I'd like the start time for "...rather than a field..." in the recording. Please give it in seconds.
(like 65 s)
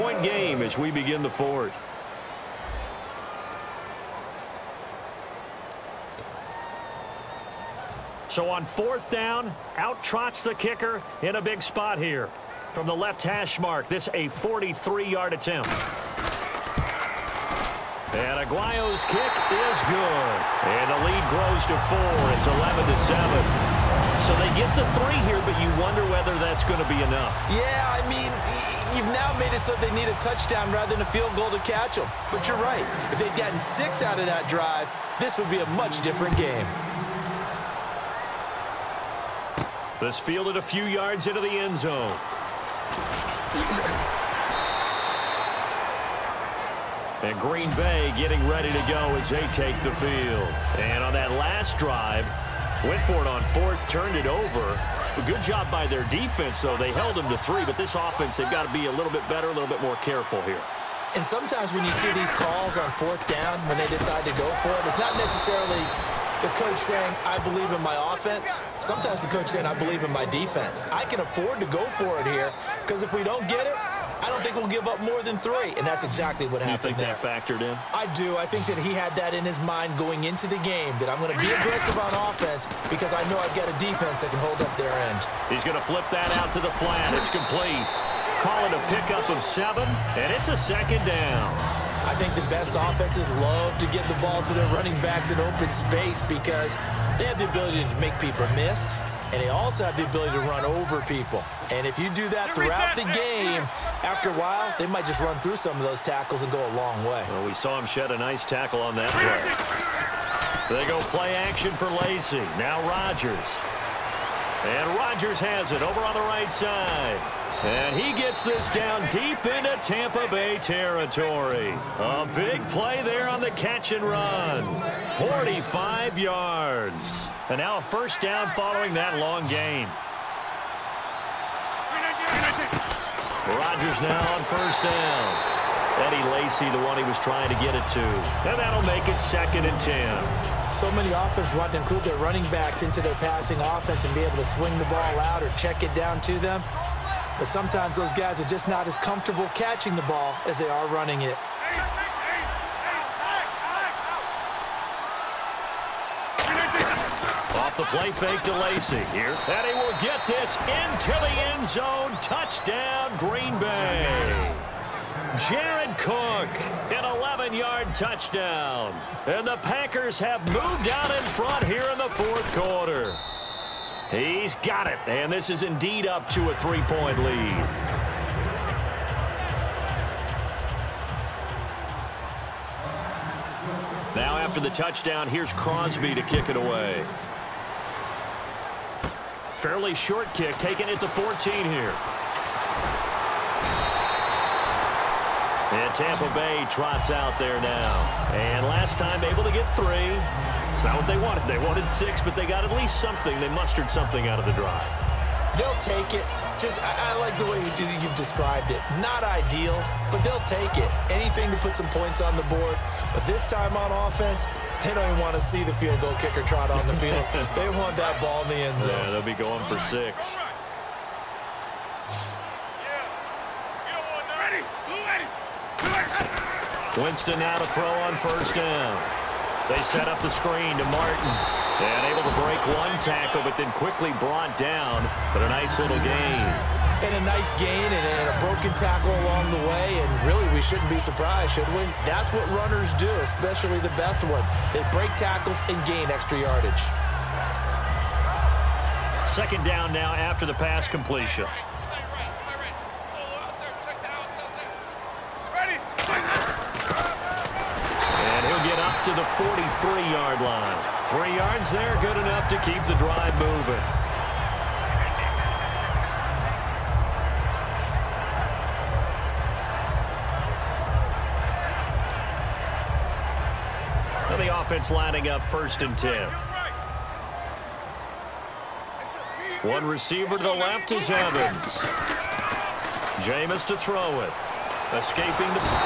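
30 s.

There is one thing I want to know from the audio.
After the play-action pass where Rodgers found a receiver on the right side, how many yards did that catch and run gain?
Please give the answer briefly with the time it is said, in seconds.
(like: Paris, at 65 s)
45, at 125 s.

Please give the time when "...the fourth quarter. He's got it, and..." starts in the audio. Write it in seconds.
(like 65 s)
171 s.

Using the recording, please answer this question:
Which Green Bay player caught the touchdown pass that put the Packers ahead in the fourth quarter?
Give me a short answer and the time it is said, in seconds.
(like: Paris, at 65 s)
Jared Cook, at 165 s.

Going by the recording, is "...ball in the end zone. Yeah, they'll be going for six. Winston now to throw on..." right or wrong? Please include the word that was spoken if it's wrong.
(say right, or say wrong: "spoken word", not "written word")
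right.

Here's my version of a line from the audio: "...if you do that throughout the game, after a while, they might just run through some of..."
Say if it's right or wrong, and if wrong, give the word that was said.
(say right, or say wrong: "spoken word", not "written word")
right.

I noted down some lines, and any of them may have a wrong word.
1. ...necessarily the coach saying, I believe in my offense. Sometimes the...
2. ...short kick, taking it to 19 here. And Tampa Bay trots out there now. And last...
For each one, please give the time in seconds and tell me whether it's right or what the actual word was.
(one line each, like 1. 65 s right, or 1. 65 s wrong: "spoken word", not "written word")
1. 65 s right
2. 189 s wrong: "14", not "19".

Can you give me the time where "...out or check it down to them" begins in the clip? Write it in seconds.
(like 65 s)
145 s.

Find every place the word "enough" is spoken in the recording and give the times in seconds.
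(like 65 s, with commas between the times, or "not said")
27 s, 262 s.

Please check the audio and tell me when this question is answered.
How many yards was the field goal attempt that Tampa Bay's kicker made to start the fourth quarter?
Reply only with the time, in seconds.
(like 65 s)
14 s.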